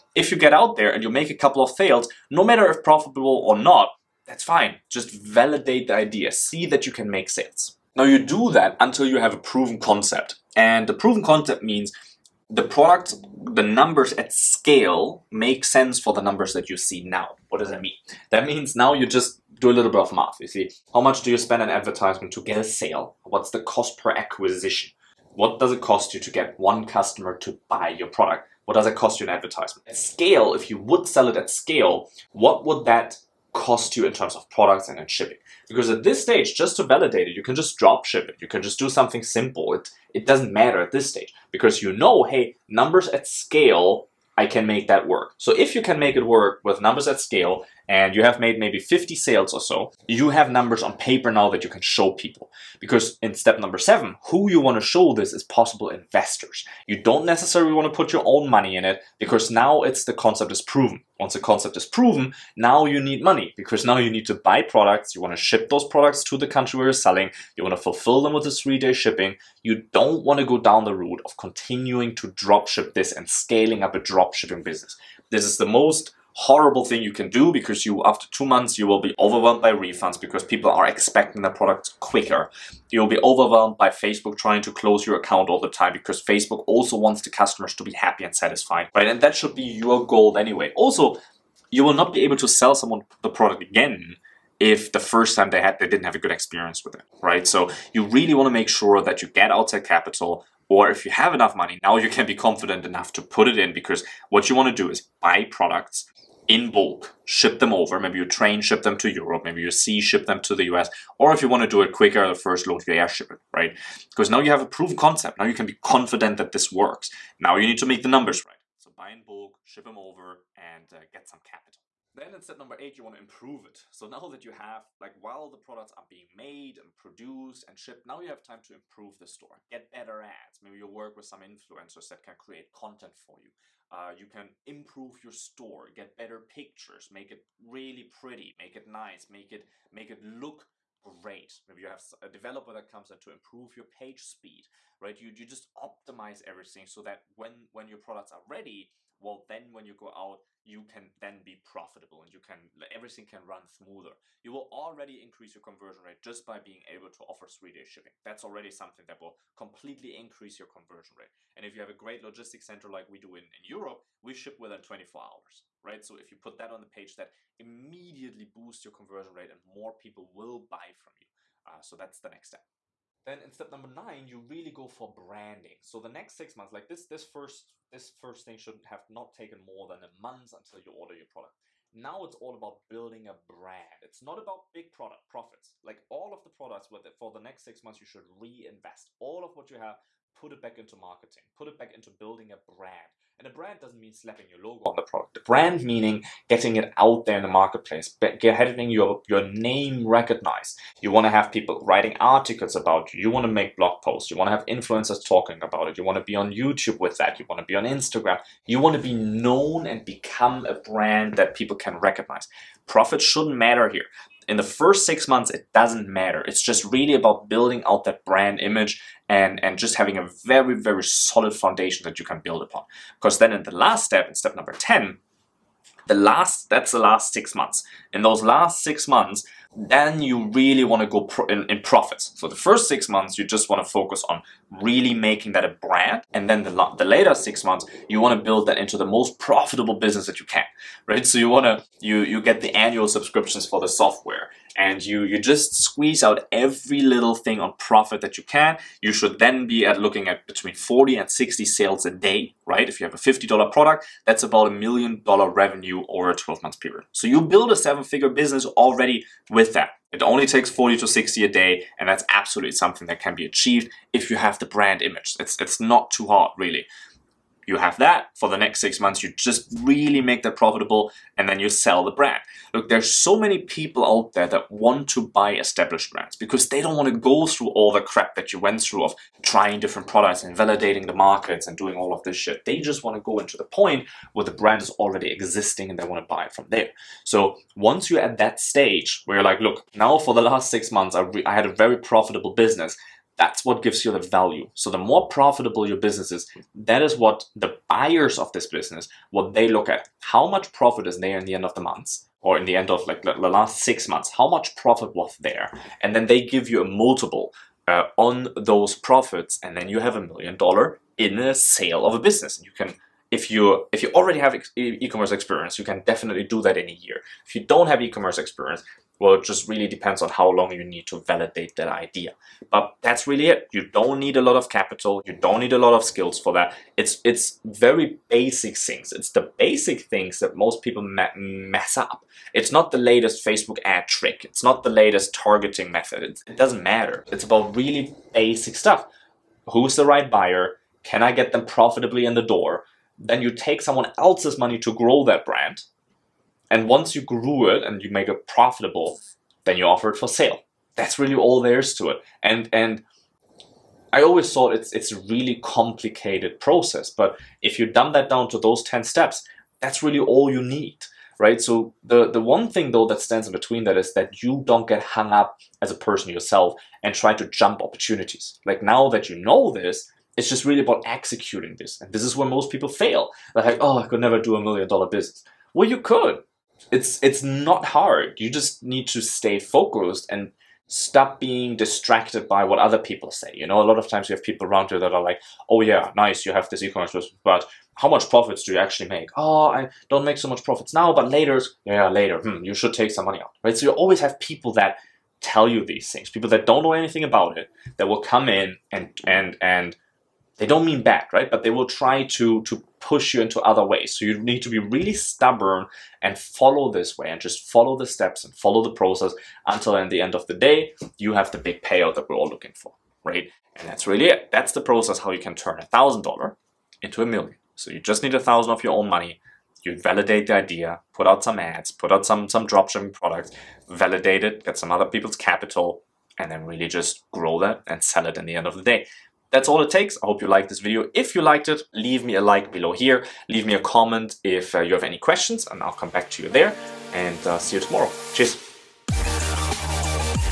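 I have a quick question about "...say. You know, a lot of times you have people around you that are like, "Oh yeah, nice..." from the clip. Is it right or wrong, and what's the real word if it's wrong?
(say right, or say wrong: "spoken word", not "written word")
right.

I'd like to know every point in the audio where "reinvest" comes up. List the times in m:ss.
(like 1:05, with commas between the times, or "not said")
3:08.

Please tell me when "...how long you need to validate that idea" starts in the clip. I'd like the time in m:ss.
5:20.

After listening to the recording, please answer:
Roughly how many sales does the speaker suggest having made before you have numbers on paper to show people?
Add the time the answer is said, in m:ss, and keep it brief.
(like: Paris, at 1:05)
50, at 0:48.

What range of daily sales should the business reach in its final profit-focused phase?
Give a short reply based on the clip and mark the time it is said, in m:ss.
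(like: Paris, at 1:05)
40 to 60, at 4:10.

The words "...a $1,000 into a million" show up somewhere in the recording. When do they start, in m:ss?
6:55.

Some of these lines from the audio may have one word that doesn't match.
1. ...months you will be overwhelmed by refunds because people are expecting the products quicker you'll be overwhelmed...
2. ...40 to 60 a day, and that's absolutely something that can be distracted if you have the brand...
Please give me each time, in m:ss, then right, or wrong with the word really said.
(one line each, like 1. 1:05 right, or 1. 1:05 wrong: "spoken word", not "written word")
1. 1:18 right
2. 4:20 wrong: "achieved", not "distracted".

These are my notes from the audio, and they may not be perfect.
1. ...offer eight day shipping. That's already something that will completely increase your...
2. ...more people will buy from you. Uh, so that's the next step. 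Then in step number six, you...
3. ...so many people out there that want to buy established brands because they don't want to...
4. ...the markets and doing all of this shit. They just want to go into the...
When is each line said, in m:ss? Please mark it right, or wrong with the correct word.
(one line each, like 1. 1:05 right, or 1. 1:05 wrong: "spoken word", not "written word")
1. 2:37 wrong: "three", not "eight"
2. 2:49 wrong: "nine", not "six"
3. 4:33 right
4. 4:41 right.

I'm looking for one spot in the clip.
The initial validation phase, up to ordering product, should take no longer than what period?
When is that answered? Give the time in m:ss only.
3:00.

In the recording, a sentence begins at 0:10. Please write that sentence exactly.
And the proven concept means the product, the numbers at scale make sense for the numbers that you see now.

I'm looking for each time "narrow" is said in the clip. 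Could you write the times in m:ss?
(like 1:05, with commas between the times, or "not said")
not said.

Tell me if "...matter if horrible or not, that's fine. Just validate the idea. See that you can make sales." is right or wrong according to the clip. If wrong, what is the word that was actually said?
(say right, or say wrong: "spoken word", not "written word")
wrong: "profitable", not "horrible".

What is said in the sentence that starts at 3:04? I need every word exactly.
It's not about big product profits.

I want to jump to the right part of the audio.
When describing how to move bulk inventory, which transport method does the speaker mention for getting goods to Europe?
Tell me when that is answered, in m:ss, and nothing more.
1:48.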